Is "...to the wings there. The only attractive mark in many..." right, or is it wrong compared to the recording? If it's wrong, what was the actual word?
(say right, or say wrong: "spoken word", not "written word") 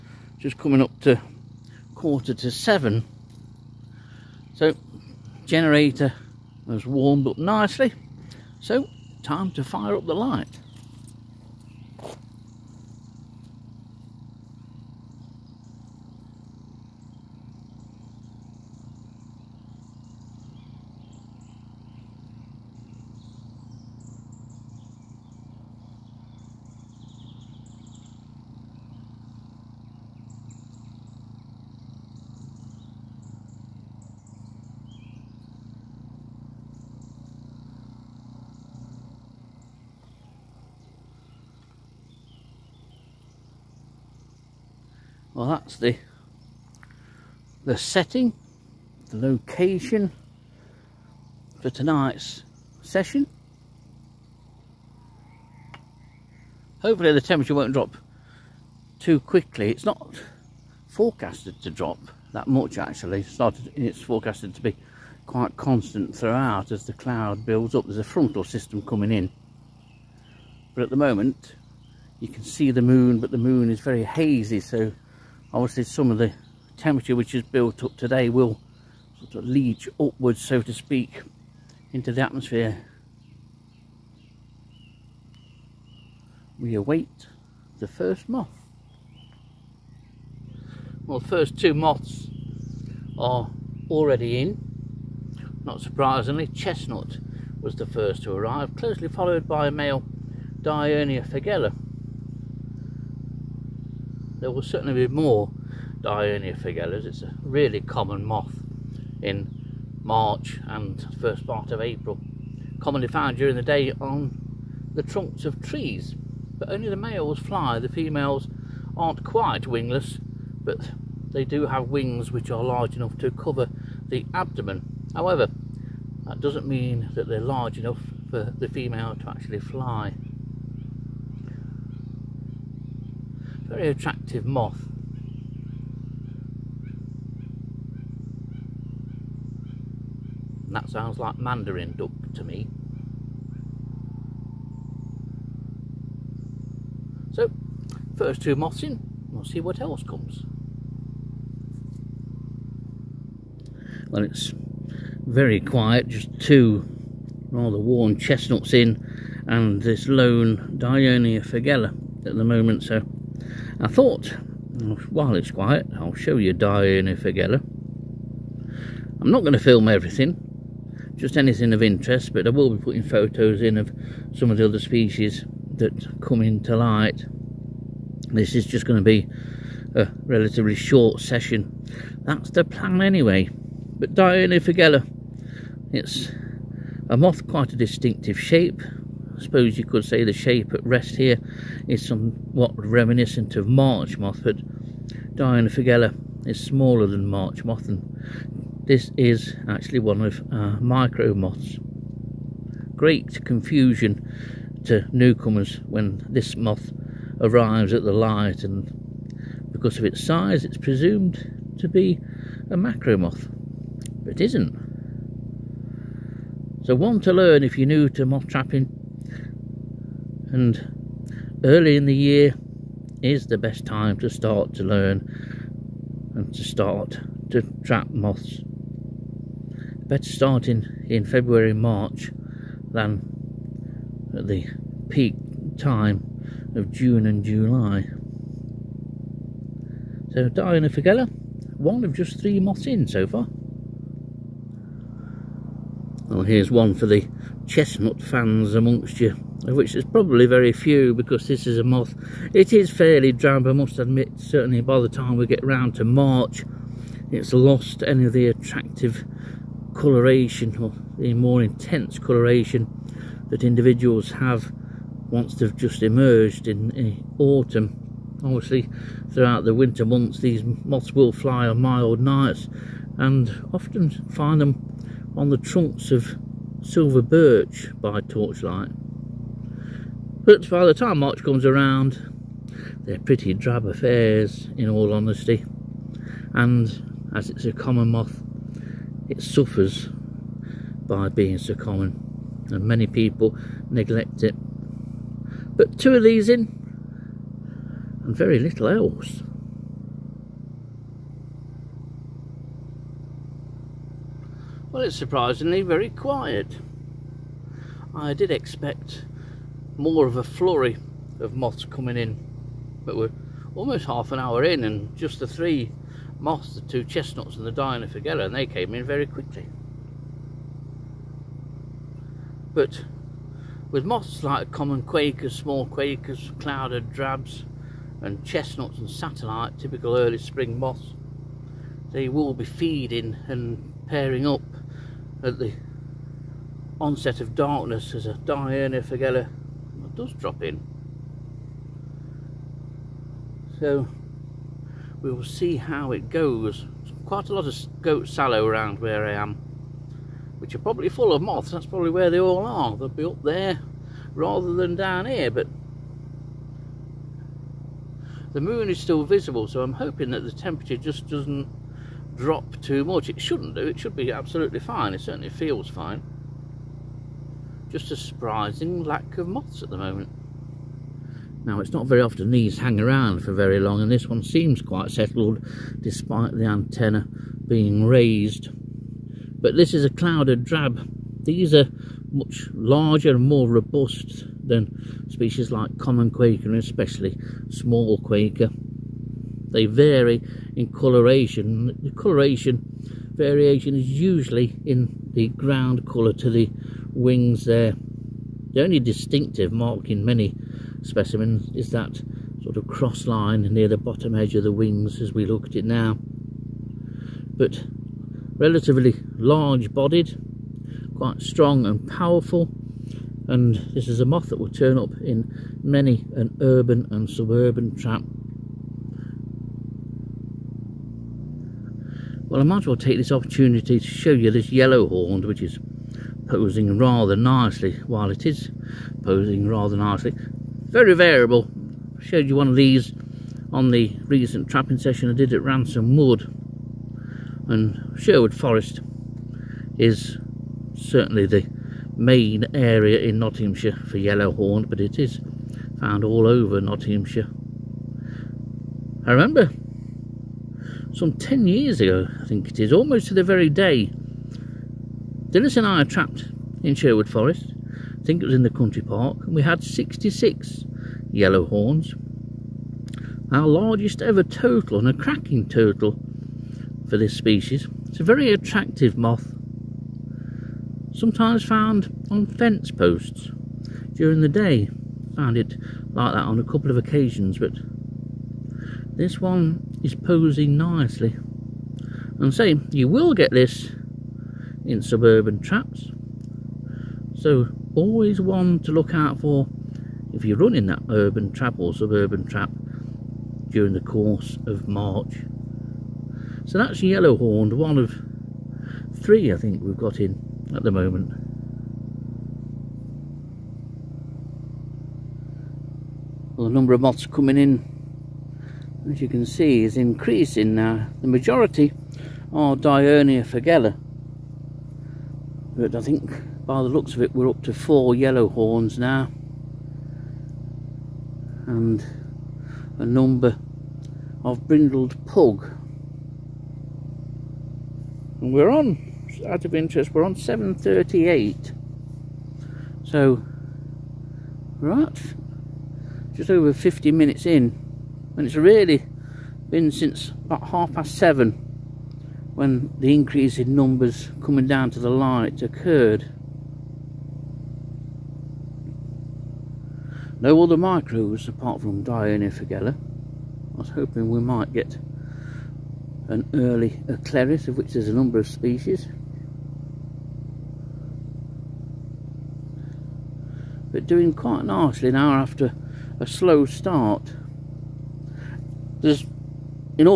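wrong: "distinctive", not "attractive".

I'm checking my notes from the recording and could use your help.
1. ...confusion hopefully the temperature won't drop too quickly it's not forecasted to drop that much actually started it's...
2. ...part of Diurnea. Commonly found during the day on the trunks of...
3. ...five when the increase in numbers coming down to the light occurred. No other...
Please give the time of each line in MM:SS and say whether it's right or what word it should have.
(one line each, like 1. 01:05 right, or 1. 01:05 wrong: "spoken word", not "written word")
1. 00:52 wrong: "session", not "confusion"
2. 01:51 wrong: "April", not "Diurnea"
3. 09:01 wrong: "seven", not "five".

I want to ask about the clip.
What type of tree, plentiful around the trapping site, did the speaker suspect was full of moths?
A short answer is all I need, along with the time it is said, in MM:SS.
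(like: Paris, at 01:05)
goat sallow, at 05:48.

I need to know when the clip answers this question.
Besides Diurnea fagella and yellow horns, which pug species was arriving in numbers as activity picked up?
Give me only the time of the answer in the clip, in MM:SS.
08:44.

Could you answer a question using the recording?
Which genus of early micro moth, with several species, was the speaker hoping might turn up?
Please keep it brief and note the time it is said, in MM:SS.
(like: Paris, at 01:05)
Acleris, at 09:17.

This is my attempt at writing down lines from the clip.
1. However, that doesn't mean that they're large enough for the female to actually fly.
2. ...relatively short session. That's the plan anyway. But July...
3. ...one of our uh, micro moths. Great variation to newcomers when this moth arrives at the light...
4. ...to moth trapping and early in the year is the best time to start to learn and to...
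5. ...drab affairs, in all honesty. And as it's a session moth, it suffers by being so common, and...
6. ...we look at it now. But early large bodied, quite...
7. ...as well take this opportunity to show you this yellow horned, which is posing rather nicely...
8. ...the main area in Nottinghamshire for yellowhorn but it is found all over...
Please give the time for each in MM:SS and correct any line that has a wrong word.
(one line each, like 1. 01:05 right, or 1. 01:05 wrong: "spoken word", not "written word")
1. 02:05 right
2. 03:00 wrong: "Diurnea", not "July"
3. 03:19 wrong: "confusion", not "variation"
4. 03:38 right
5. 04:43 wrong: "common", not "session"
6. 06:45 wrong: "relatively", not "early"
7. 07:02 right
8. 07:21 right.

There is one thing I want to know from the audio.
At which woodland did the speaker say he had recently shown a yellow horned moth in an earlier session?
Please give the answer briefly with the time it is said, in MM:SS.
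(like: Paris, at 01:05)
Ransom Wood, at 07:15.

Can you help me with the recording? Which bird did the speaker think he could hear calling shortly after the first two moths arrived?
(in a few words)
mandarin duck.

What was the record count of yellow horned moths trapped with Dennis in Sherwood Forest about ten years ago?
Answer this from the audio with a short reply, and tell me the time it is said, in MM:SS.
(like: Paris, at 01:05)
66, at 07:39.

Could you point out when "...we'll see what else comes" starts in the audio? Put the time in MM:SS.
02:29.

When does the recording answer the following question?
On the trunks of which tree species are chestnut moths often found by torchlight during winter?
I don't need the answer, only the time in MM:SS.
04:36.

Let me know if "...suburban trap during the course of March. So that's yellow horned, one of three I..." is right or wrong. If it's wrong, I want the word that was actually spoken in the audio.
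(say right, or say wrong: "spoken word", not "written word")
right.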